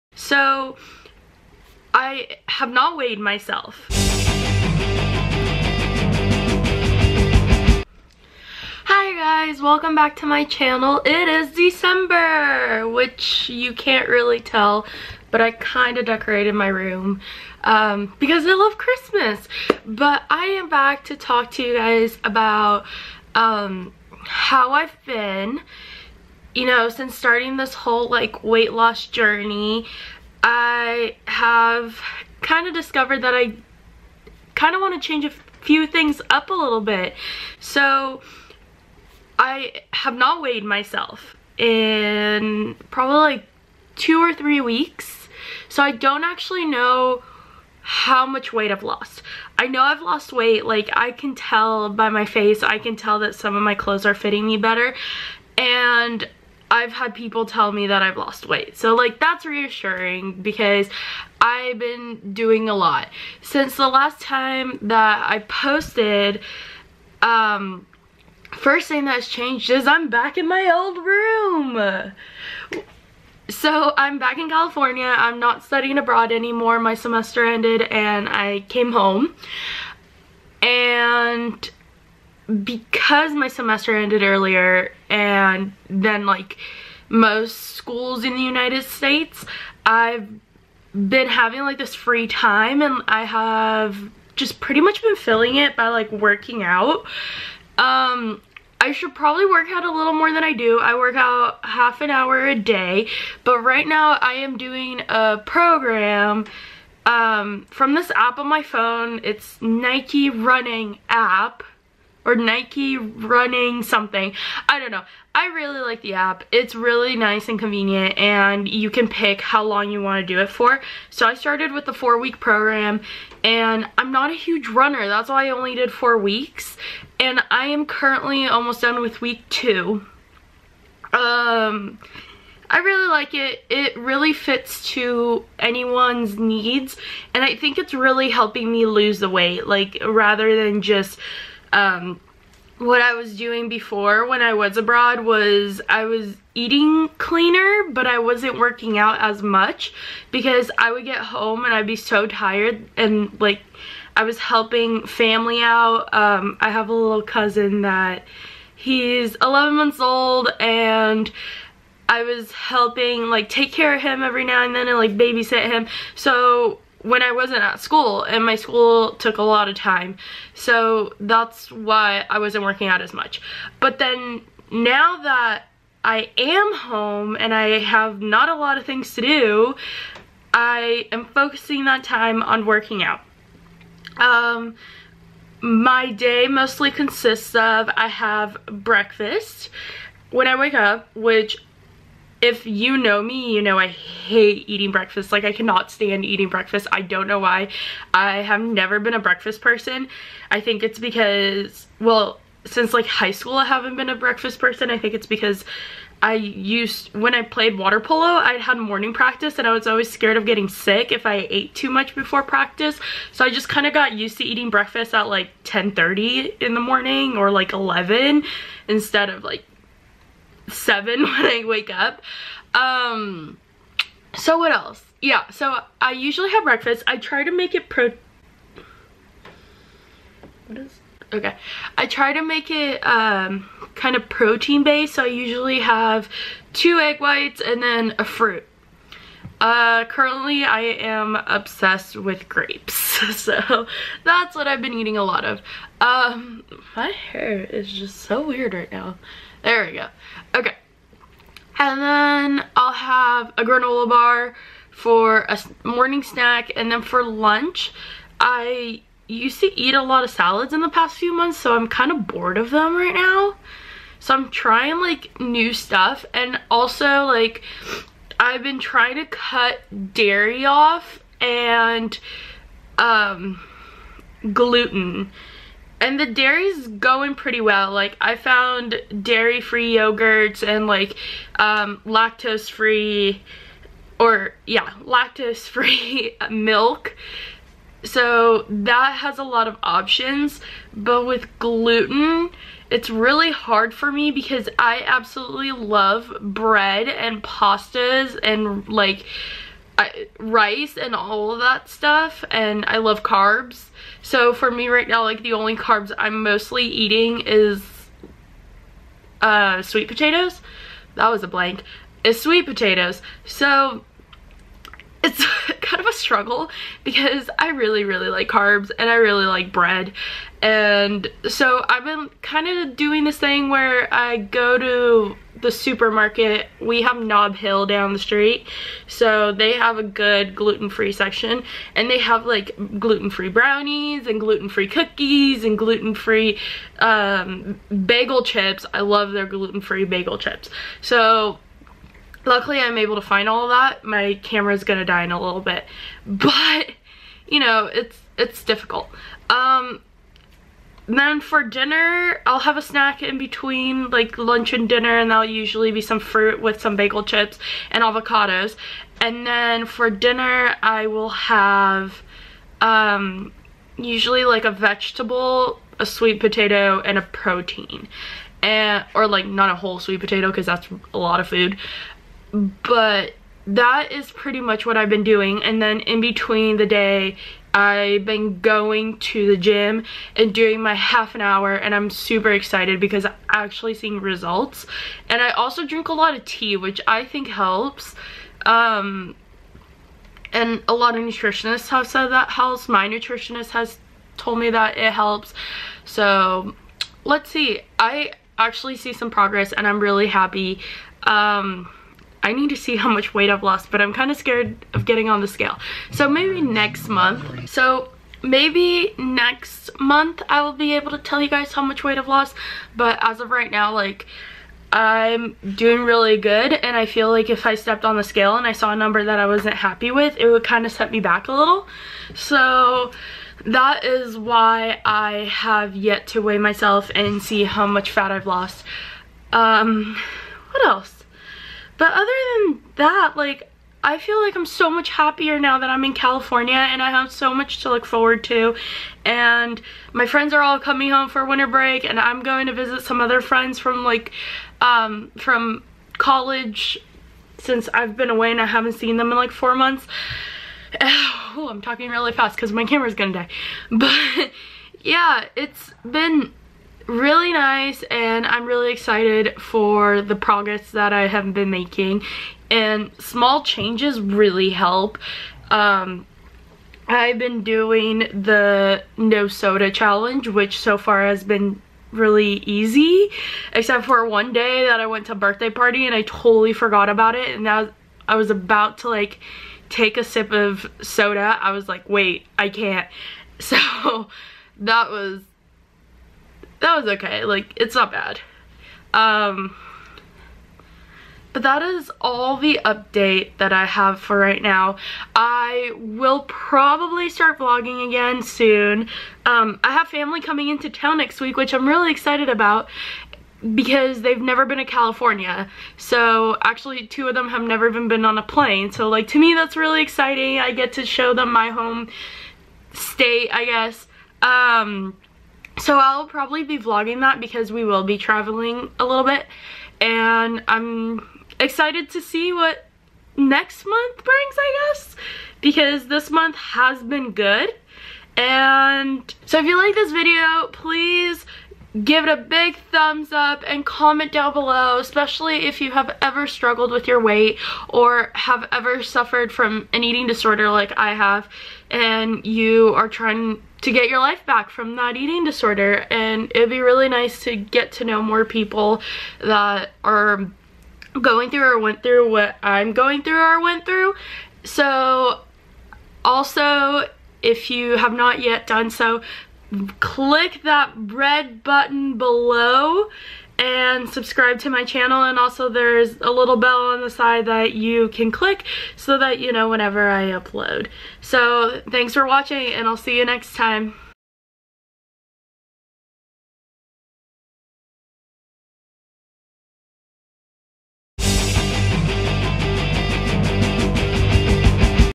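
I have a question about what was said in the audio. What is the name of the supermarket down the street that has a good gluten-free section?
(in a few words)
Nob Hill.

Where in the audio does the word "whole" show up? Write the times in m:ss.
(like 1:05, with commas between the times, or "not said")
0:27, 6:09.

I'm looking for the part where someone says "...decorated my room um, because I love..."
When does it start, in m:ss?
0:16.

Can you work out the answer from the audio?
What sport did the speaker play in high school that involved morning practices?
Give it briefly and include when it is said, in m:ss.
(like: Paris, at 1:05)
Water polo, at 3:27.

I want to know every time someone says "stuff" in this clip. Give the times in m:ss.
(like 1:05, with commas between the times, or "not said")
4:25, 5:01.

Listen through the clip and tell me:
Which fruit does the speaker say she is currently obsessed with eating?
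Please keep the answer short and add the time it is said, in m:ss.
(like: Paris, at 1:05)
Grapes, at 4:02.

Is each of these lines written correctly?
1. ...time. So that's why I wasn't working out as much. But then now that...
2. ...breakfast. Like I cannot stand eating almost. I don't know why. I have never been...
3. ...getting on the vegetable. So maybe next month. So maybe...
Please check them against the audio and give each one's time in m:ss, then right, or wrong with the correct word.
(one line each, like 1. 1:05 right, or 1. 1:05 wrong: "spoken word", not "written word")
1. 2:49 right
2. 3:14 wrong: "breakfast", not "almost"
3. 6:45 wrong: "scale", not "vegetable".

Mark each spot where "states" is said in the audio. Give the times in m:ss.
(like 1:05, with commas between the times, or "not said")
1:28, 8:32.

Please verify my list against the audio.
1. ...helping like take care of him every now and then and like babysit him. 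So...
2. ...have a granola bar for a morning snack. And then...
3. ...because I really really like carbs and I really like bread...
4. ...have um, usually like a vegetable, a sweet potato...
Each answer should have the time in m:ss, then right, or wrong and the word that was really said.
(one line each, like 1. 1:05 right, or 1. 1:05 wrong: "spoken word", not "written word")
1. 2:42 right
2. 4:12 right
3. 5:17 right
4. 6:01 right.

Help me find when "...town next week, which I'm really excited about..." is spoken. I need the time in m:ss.
8:20.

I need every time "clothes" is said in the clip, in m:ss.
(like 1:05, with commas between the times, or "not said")
0:53.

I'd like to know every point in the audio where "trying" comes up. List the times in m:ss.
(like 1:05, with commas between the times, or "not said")
4:24, 4:28, 9:03.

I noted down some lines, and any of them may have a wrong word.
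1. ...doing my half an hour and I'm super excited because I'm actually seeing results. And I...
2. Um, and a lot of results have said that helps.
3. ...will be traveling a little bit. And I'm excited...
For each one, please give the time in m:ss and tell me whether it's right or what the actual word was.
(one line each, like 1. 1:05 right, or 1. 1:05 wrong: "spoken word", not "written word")
1. 6:20 right
2. 6:28 wrong: "nutritionists", not "results"
3. 8:37 right.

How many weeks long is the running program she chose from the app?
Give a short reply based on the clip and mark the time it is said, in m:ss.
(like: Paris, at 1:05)
4 weeks, at 2:01.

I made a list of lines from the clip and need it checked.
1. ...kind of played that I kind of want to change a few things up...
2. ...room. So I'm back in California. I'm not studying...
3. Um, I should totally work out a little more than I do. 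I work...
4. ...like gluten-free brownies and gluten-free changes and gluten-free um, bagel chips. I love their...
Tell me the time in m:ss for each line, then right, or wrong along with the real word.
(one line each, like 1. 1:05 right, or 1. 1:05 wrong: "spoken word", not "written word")
1. 0:32 wrong: "discovered", not "played"
2. 1:11 right
3. 1:37 wrong: "probably", not "totally"
4. 5:32 wrong: "cookies", not "changes".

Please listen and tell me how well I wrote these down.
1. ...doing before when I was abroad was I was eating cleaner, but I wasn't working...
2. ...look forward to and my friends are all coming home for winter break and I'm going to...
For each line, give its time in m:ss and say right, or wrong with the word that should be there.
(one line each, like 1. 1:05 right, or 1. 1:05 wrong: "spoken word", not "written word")
1. 2:23 right
2. 7:17 right.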